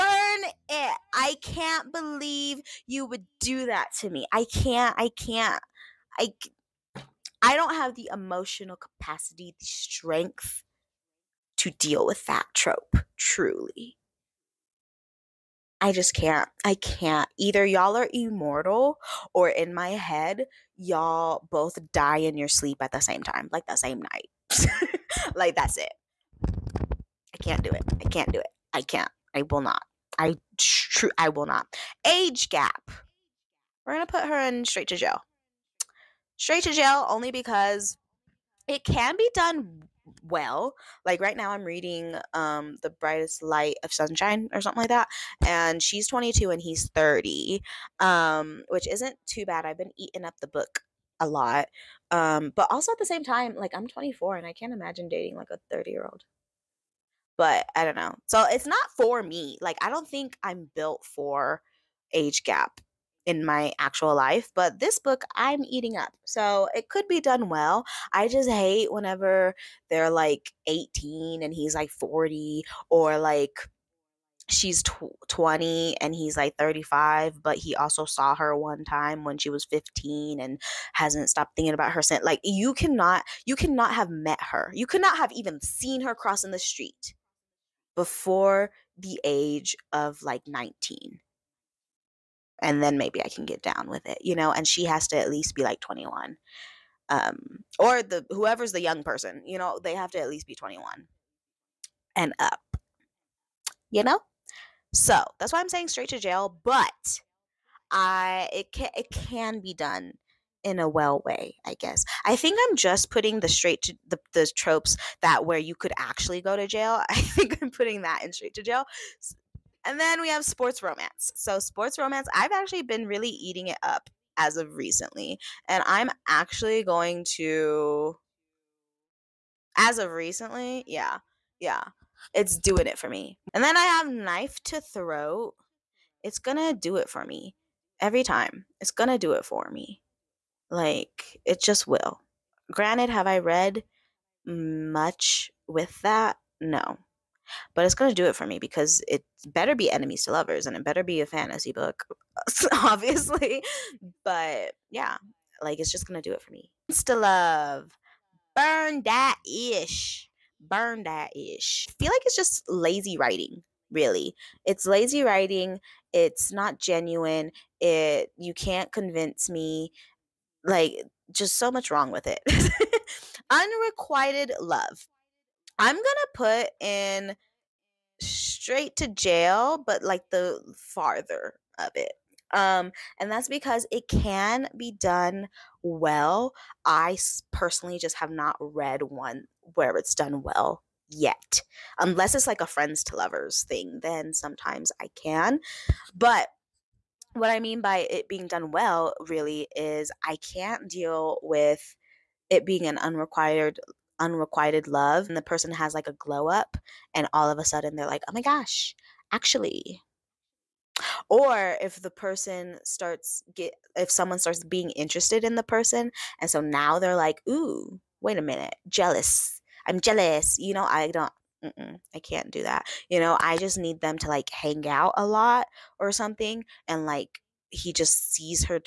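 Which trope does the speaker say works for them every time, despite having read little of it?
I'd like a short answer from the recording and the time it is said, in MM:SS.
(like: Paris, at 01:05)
knife to throat, at 02:14.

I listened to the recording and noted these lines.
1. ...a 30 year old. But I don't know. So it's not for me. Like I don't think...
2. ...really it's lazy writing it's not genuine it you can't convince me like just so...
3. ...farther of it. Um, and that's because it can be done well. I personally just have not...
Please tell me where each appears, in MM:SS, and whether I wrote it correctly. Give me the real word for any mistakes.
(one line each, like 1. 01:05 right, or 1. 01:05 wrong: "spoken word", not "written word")
1. 00:55 right
2. 02:43 right
3. 03:00 right.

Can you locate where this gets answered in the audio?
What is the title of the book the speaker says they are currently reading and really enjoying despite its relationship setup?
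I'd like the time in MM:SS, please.
00:42.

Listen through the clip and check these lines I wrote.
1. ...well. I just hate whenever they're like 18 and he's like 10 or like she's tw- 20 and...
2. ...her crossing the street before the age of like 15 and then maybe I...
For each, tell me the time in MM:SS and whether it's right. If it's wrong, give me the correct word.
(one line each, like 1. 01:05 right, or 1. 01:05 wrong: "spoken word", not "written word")
1. 01:07 wrong: "40", not "10"
2. 01:26 wrong: "19", not "15".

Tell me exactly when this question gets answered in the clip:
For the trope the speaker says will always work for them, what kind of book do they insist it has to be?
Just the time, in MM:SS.
02:31.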